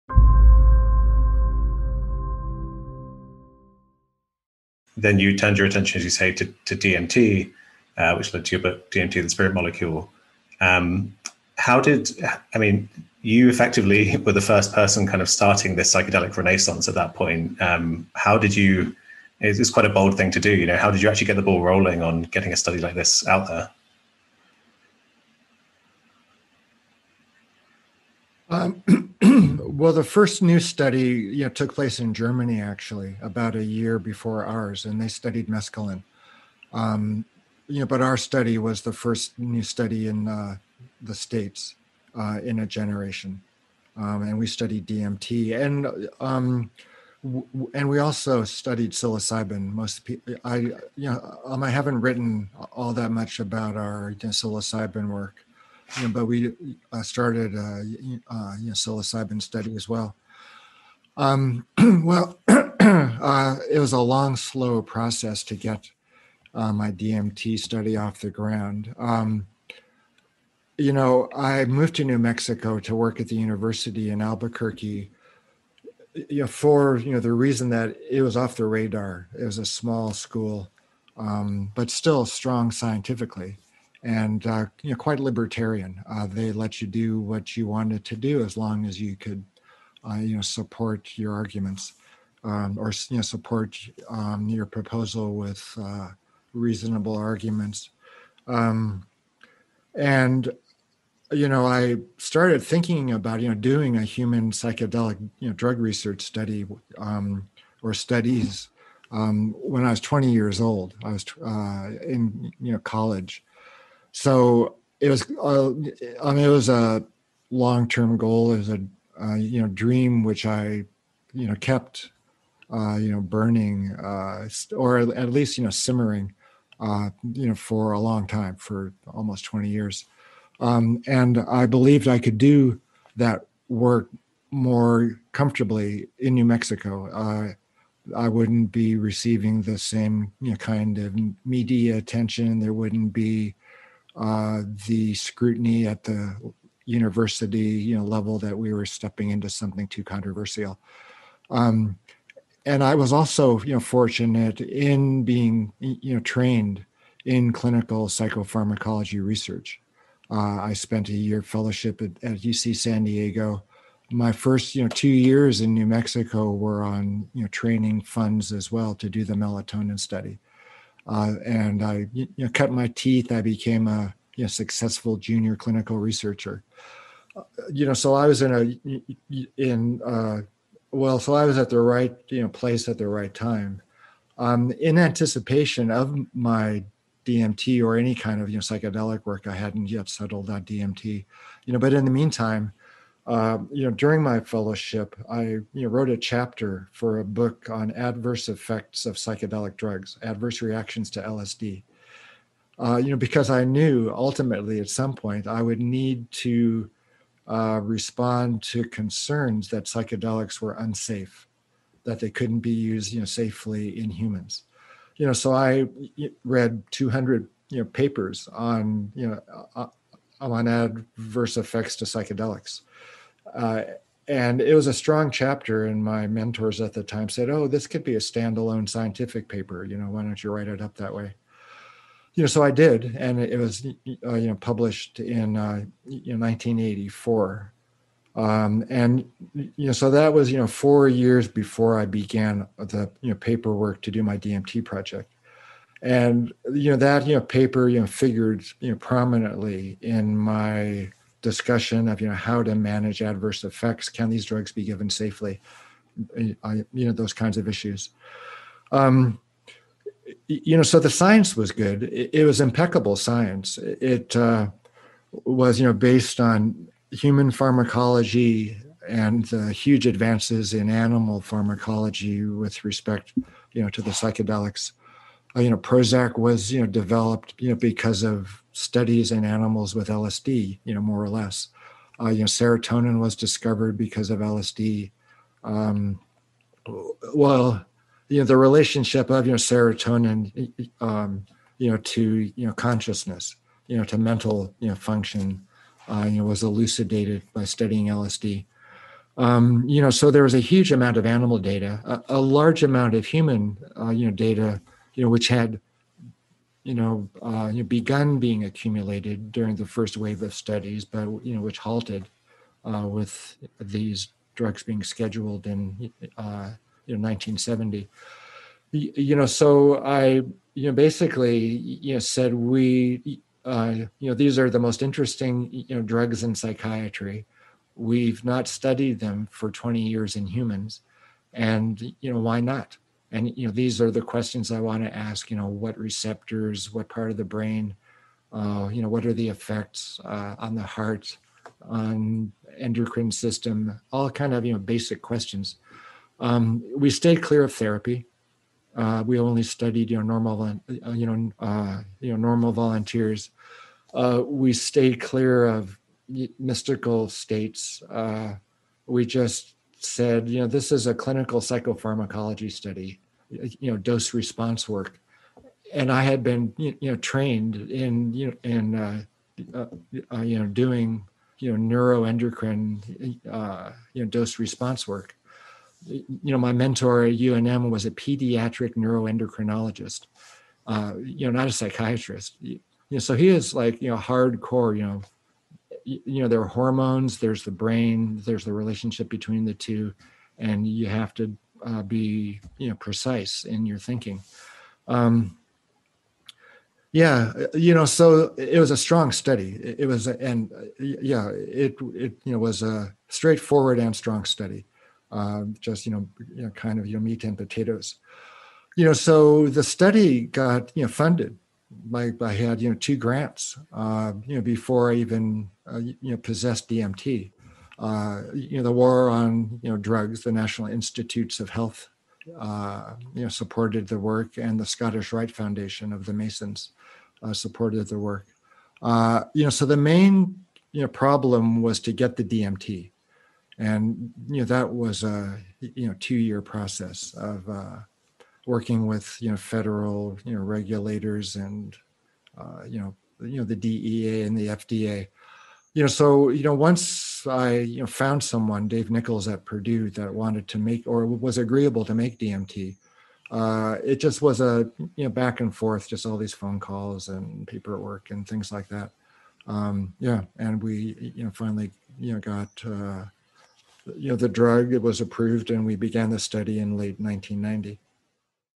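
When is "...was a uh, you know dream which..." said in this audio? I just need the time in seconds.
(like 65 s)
118 s.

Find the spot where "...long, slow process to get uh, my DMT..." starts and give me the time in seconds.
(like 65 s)
63 s.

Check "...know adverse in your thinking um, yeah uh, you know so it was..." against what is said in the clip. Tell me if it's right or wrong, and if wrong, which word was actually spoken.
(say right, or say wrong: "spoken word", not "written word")
wrong: "precise", not "adverse".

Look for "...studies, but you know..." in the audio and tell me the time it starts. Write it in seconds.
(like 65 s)
310 s.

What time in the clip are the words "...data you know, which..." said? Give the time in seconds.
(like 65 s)
304 s.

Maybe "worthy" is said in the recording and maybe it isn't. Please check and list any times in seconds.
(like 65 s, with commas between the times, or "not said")
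not said.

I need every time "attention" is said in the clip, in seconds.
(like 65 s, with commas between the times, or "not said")
5 s, 141 s.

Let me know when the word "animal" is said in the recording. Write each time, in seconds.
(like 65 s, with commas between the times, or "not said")
270 s, 279 s, 301 s.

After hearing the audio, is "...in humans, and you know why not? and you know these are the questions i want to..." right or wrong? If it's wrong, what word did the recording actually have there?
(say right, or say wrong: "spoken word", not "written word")
right.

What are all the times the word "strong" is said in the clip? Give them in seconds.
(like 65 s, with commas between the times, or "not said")
82 s, 224 s, 398 s, 404 s.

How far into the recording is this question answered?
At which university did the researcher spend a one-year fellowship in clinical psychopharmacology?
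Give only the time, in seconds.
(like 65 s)
162 s.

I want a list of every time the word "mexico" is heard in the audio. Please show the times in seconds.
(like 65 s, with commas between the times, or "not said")
72 s, 136 s, 165 s.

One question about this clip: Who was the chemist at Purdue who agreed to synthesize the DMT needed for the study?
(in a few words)
Dave Nichols.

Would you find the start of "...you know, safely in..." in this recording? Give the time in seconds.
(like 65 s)
213 s.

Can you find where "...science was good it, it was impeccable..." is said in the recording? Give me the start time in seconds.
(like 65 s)
261 s.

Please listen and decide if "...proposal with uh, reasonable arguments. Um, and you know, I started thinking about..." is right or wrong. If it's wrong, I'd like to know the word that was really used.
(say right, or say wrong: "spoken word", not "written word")
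right.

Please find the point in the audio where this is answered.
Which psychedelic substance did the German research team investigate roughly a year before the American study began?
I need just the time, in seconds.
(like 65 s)
35 s.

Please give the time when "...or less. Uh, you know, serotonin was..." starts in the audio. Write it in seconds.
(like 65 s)
281 s.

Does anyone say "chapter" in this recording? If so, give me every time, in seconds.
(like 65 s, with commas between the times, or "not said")
196 s, 225 s.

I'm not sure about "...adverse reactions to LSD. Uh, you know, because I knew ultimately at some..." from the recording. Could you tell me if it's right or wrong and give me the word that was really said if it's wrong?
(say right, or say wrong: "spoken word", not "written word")
right.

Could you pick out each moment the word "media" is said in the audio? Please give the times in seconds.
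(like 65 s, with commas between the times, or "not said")
141 s.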